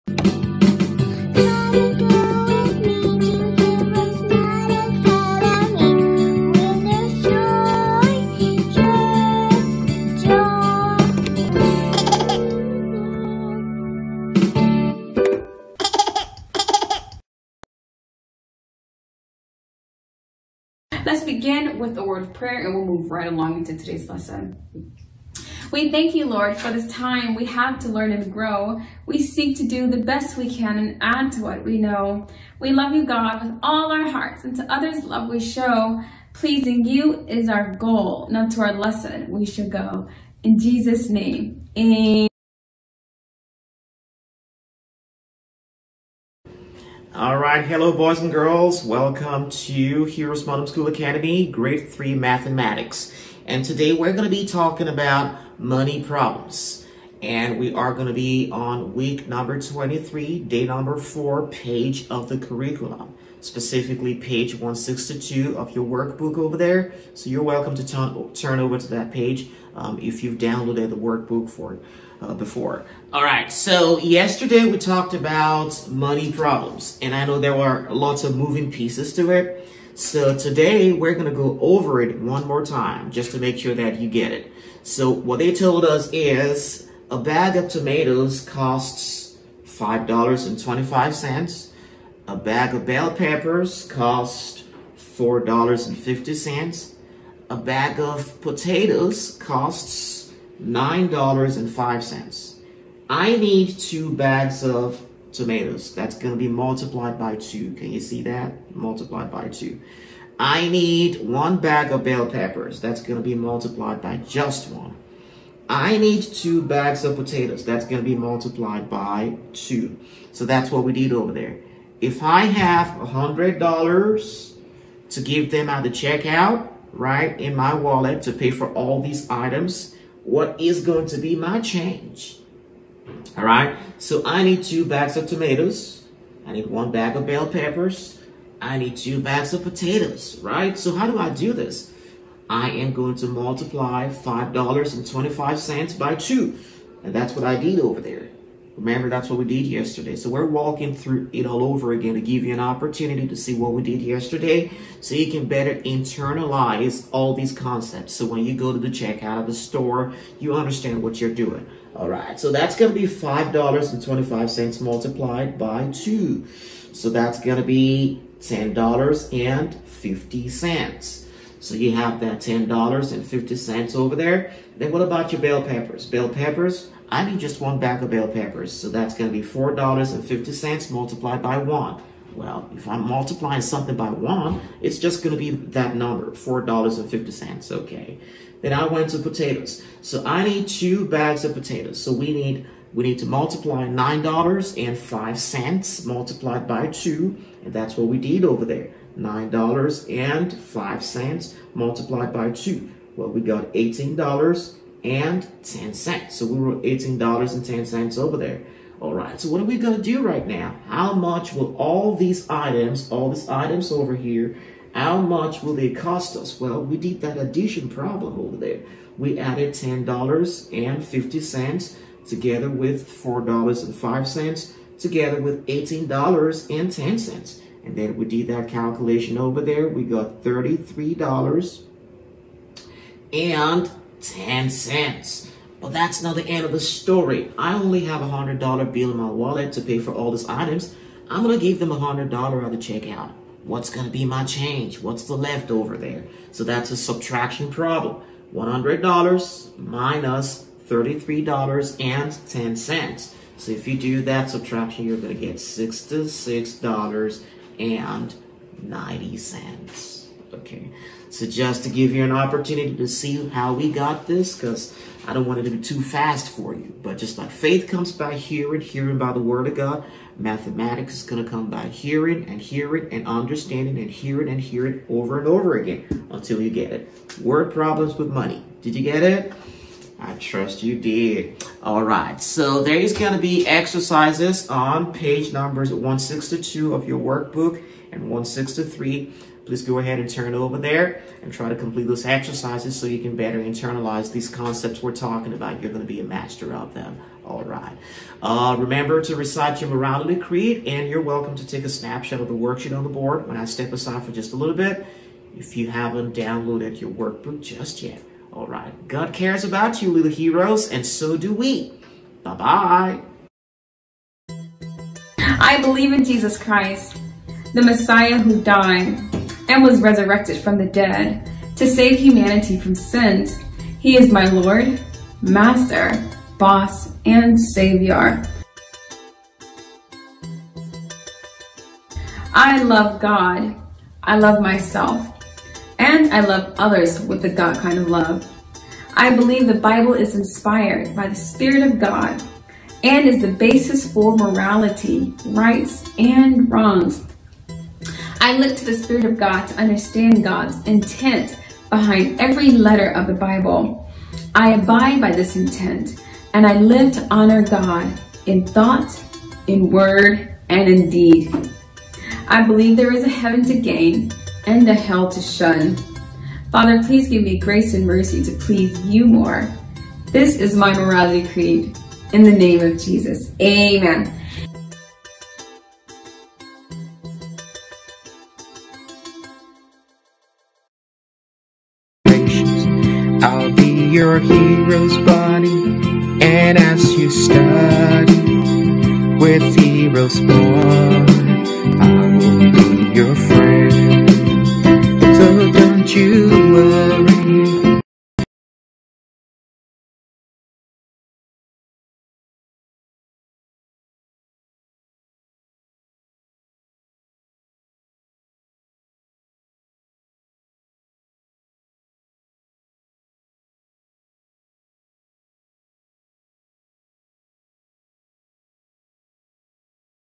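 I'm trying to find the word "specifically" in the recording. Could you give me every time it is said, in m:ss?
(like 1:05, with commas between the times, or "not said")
1:03.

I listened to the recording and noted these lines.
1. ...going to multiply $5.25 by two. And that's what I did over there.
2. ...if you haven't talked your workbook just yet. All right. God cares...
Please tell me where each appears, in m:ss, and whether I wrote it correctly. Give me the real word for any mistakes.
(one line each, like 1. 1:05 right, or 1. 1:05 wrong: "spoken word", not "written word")
1. 2:22 right
2. 5:05 wrong: "downloaded", not "talked".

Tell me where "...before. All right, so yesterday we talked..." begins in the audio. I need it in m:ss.
1:12.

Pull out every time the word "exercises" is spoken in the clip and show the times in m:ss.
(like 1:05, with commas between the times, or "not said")
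4:43, 4:52.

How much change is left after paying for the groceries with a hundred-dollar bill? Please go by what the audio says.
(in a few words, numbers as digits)
$66.90.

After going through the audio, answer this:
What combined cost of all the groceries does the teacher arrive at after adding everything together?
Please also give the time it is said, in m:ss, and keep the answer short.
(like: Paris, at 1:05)
$33.10, at 3:50.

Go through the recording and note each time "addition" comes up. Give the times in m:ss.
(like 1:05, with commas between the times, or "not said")
3:37.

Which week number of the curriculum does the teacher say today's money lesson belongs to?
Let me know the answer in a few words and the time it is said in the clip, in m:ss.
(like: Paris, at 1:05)
23, at 0:59.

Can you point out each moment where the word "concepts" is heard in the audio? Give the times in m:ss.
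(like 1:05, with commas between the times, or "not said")
2:37, 4:54.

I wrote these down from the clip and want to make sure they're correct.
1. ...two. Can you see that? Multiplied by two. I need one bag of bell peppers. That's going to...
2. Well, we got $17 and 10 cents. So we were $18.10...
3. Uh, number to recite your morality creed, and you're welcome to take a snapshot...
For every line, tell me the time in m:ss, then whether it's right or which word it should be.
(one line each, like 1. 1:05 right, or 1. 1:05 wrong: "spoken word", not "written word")
1. 1:47 right
2. 3:23 wrong: "18", not "17"
3. 4:58 wrong: "remember", not "number".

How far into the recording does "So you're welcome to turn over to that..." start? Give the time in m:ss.
1:07.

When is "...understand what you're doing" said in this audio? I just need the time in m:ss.
2:40.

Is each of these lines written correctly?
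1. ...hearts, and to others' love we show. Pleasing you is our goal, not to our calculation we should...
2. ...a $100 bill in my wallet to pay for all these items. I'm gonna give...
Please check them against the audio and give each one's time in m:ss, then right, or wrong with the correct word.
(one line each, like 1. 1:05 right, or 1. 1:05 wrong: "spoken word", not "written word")
1. 0:34 wrong: "lesson", not "calculation"
2. 3:58 right.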